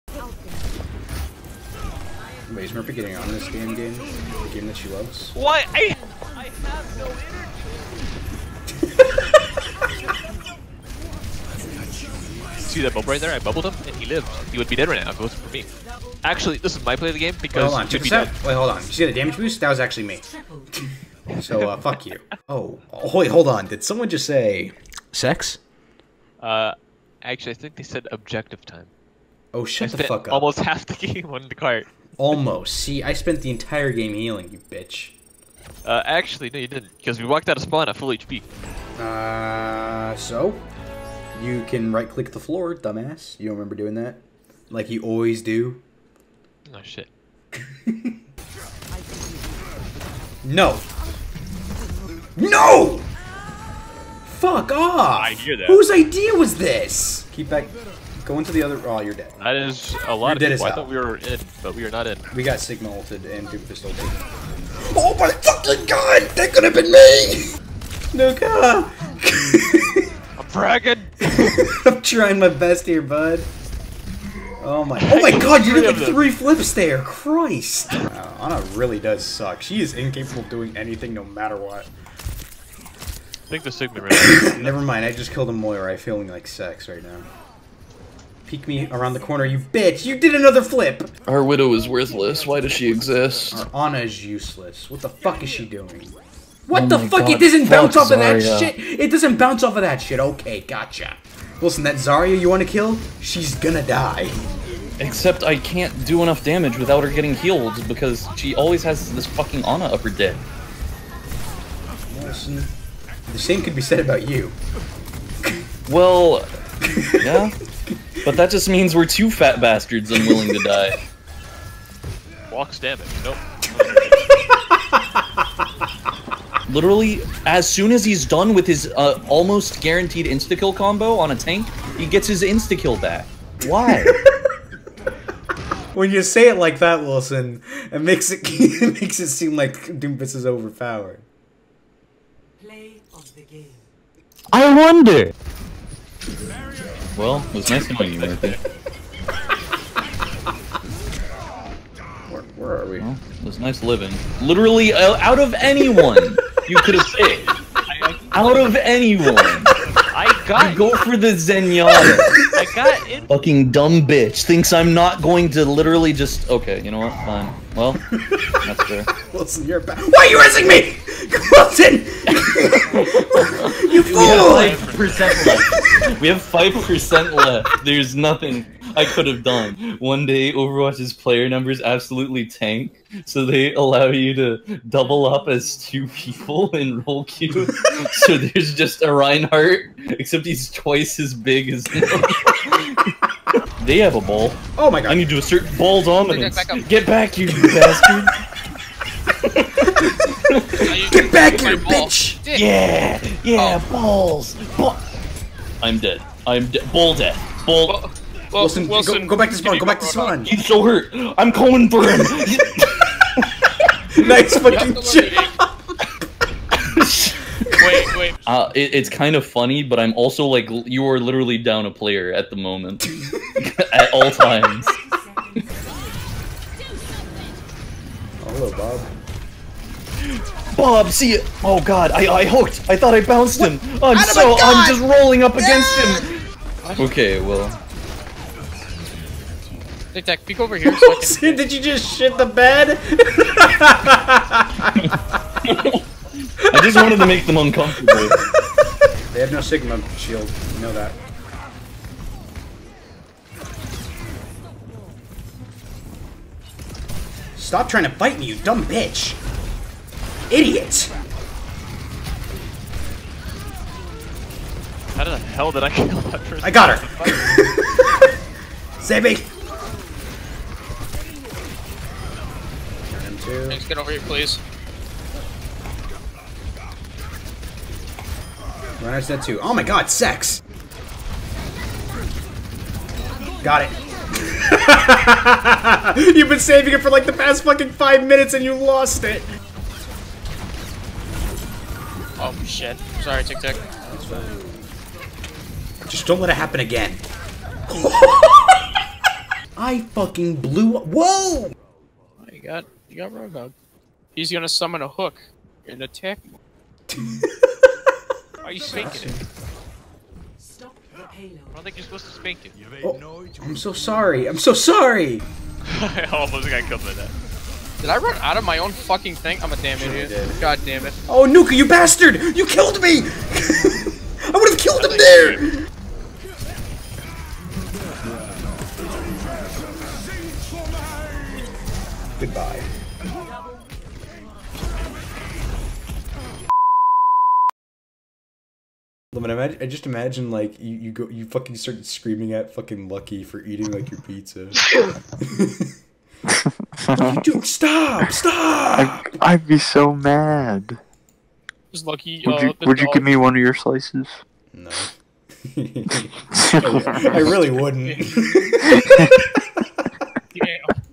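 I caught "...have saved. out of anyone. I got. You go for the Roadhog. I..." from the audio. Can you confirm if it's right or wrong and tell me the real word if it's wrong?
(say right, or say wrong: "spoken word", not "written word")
wrong: "Zenyatta", not "Roadhog".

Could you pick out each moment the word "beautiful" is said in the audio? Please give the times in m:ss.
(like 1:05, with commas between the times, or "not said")
not said.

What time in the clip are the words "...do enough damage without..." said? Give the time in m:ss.
1:46.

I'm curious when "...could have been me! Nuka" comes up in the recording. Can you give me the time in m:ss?
1:06.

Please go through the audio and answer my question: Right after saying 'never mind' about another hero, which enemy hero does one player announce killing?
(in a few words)
Moira.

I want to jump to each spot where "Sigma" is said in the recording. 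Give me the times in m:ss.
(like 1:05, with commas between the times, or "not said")
1:02, 1:23, 4:09.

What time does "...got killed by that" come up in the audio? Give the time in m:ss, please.
5:16.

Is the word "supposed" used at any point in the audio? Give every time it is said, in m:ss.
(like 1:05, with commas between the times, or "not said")
5:12.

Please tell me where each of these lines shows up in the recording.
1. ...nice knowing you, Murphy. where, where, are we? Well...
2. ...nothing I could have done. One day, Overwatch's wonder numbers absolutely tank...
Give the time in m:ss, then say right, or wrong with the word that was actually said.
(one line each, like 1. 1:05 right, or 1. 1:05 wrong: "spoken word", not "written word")
1. 2:27 right
2. 2:58 wrong: "player", not "wonder".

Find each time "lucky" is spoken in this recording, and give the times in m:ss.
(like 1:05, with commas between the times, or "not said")
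5:43, 5:52.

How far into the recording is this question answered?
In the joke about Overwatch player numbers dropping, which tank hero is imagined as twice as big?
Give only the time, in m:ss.
3:09.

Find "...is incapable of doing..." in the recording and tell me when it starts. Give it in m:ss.
1:19.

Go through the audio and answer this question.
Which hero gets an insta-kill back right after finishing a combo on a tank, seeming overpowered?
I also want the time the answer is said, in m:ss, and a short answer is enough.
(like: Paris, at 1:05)
Doomfist, at 2:19.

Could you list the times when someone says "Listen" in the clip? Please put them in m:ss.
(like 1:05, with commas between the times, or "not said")
1:41, 1:52.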